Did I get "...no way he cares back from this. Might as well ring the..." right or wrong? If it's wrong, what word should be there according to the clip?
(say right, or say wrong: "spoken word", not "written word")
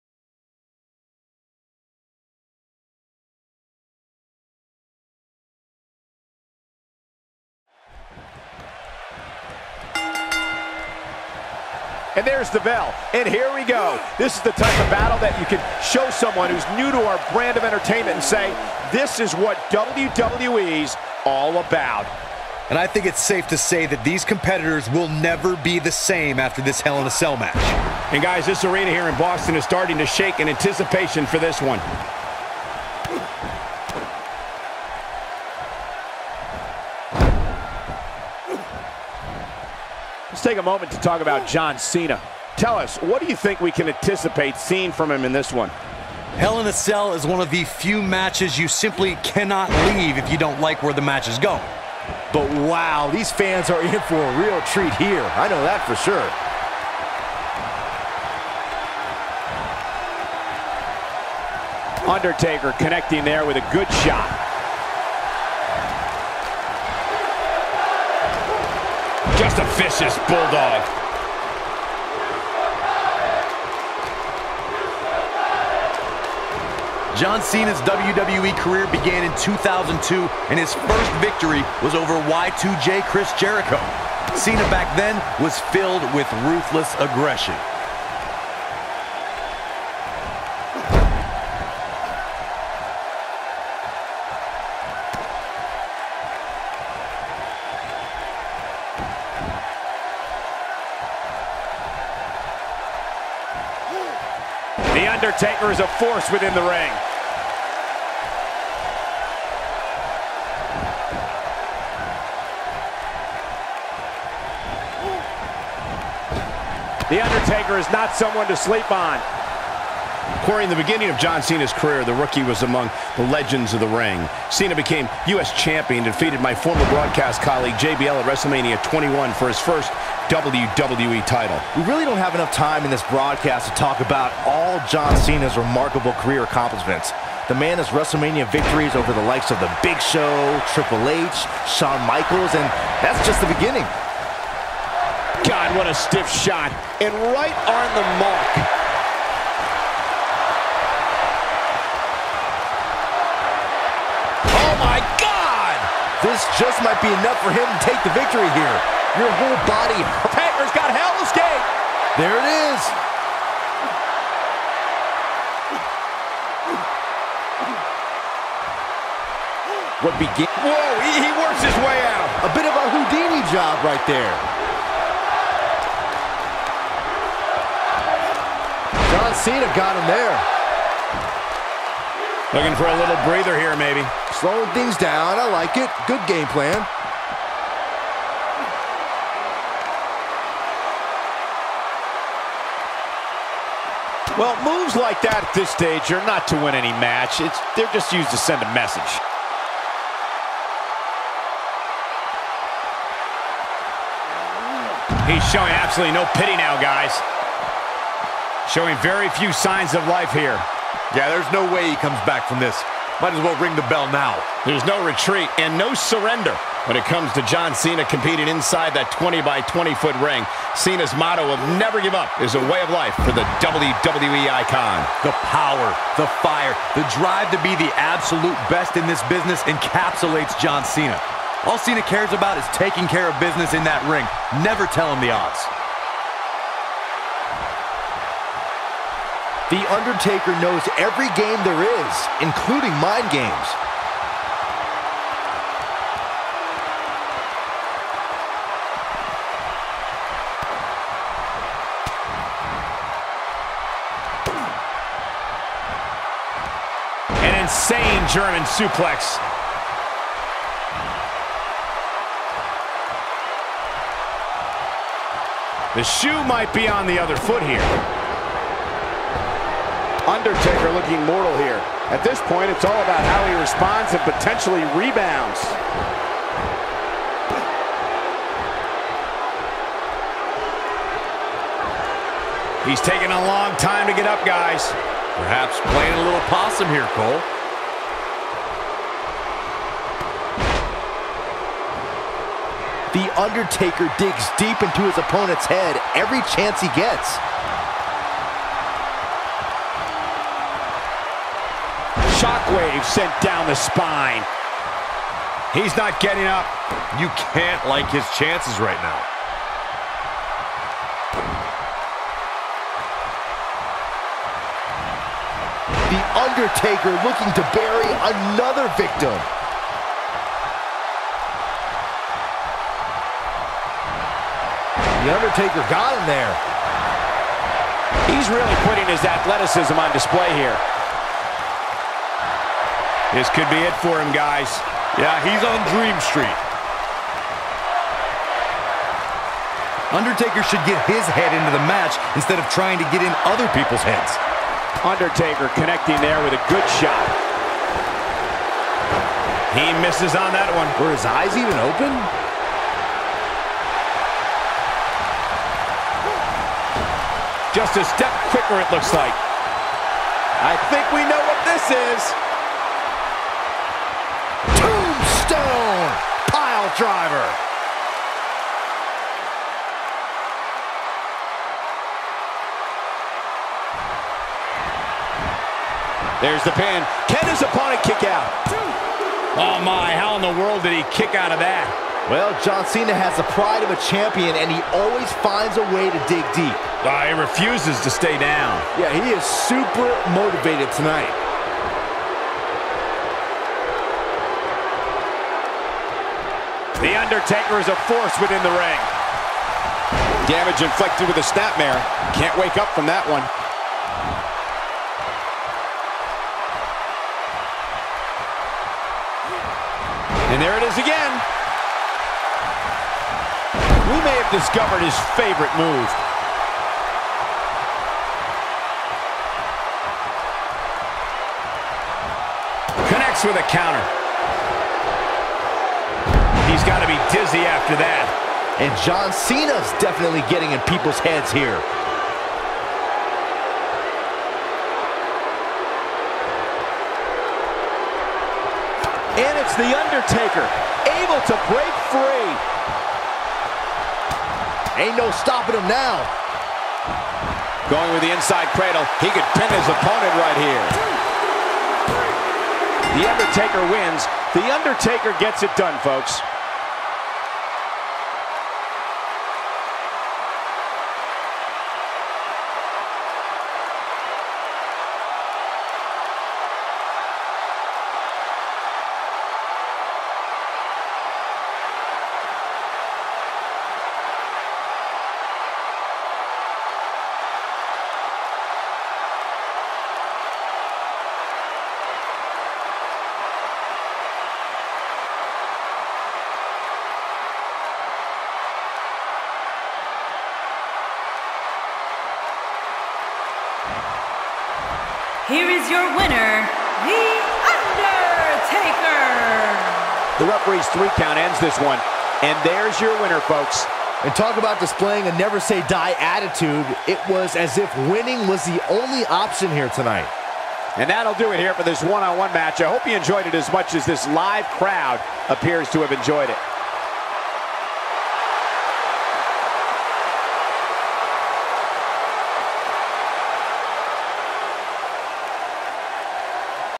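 wrong: "comes", not "cares".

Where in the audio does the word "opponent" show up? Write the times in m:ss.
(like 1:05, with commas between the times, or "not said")
4:55, 6:17, 7:29.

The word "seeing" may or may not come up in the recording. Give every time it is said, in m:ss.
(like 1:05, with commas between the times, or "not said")
0:44.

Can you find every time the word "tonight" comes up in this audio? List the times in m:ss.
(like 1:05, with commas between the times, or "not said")
6:30, 8:29.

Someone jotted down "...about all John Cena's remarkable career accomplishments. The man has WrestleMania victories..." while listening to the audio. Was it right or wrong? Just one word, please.
right.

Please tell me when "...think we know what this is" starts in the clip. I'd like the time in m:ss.
6:00.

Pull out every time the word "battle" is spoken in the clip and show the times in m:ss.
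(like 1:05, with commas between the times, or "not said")
0:14.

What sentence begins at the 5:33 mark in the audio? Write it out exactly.
This could be it for him, guys.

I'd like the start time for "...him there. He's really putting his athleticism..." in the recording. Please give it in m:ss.
5:26.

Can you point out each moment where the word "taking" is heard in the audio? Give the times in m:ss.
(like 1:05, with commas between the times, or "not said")
3:52, 4:43.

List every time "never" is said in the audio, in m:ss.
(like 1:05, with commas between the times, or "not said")
0:25, 3:41, 3:54, 8:25.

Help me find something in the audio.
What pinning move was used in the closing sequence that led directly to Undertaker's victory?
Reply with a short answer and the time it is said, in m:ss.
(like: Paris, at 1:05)
Inside cradle, at 7:28.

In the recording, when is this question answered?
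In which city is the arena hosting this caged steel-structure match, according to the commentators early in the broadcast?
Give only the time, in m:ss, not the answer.
0:29.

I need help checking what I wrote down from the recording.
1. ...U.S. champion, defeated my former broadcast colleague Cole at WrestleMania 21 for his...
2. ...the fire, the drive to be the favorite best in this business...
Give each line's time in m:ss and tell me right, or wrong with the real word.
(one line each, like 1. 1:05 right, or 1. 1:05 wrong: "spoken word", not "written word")
1. 2:05 wrong: "JBL", not "Cole"
2. 3:46 wrong: "absolute", not "favorite".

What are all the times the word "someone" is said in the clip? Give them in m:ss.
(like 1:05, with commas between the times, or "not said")
0:16, 1:58.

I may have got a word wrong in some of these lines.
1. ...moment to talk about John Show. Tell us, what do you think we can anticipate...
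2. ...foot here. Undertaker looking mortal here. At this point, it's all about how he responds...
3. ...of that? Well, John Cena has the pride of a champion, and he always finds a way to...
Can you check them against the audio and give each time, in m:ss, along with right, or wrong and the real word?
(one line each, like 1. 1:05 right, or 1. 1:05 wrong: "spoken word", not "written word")
1. 0:40 wrong: "Cena", not "Show"
2. 4:27 right
3. 6:21 right.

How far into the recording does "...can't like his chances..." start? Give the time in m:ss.
5:07.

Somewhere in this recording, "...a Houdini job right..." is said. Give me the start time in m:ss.
2:52.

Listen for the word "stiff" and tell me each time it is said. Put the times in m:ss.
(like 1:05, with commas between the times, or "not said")
2:25.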